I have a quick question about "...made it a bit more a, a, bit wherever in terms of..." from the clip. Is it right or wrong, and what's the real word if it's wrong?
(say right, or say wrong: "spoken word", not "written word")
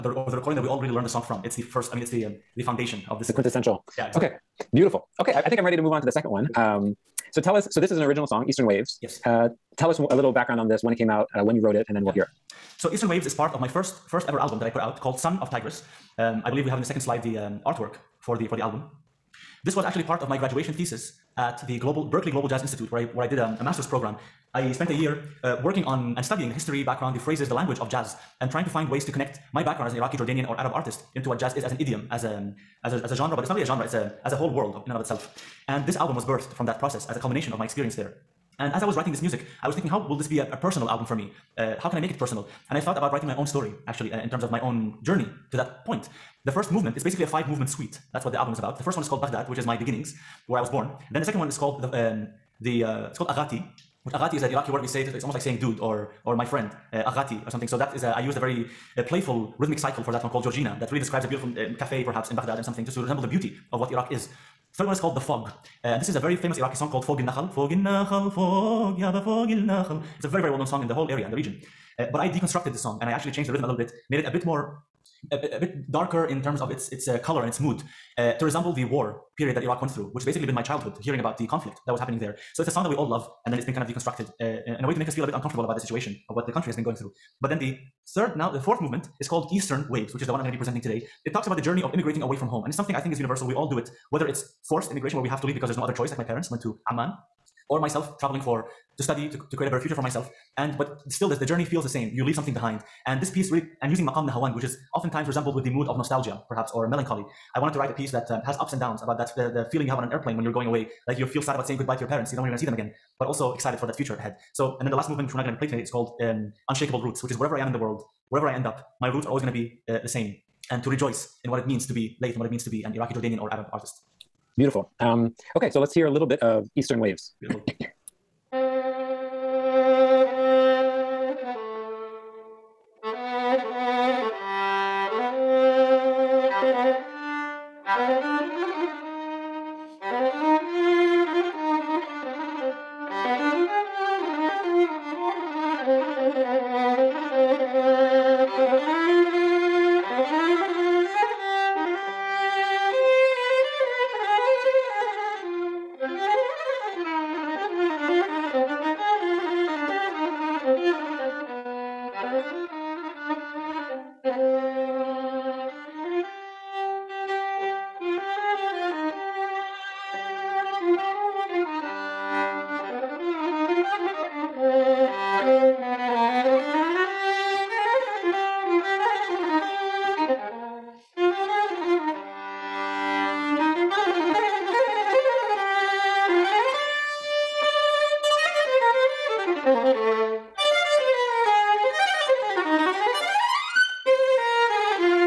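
wrong: "darker", not "wherever".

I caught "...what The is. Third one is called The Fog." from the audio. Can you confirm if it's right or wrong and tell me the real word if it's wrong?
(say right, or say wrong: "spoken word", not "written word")
wrong: "Iraq", not "The".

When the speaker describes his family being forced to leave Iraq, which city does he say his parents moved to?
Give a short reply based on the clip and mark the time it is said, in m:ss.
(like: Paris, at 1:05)
Amman, at 1:36.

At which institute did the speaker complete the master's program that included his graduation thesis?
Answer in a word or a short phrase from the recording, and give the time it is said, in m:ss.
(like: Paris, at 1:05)
Berklee Global Jazz Institute, at 0:22.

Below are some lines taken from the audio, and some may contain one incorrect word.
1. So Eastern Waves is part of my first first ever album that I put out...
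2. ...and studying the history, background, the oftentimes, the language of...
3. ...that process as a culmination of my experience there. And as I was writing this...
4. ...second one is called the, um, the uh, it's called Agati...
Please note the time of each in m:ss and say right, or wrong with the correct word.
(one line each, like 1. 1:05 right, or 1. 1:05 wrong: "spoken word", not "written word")
1. 0:12 right
2. 0:26 wrong: "phrases", not "oftentimes"
3. 0:36 right
4. 0:51 right.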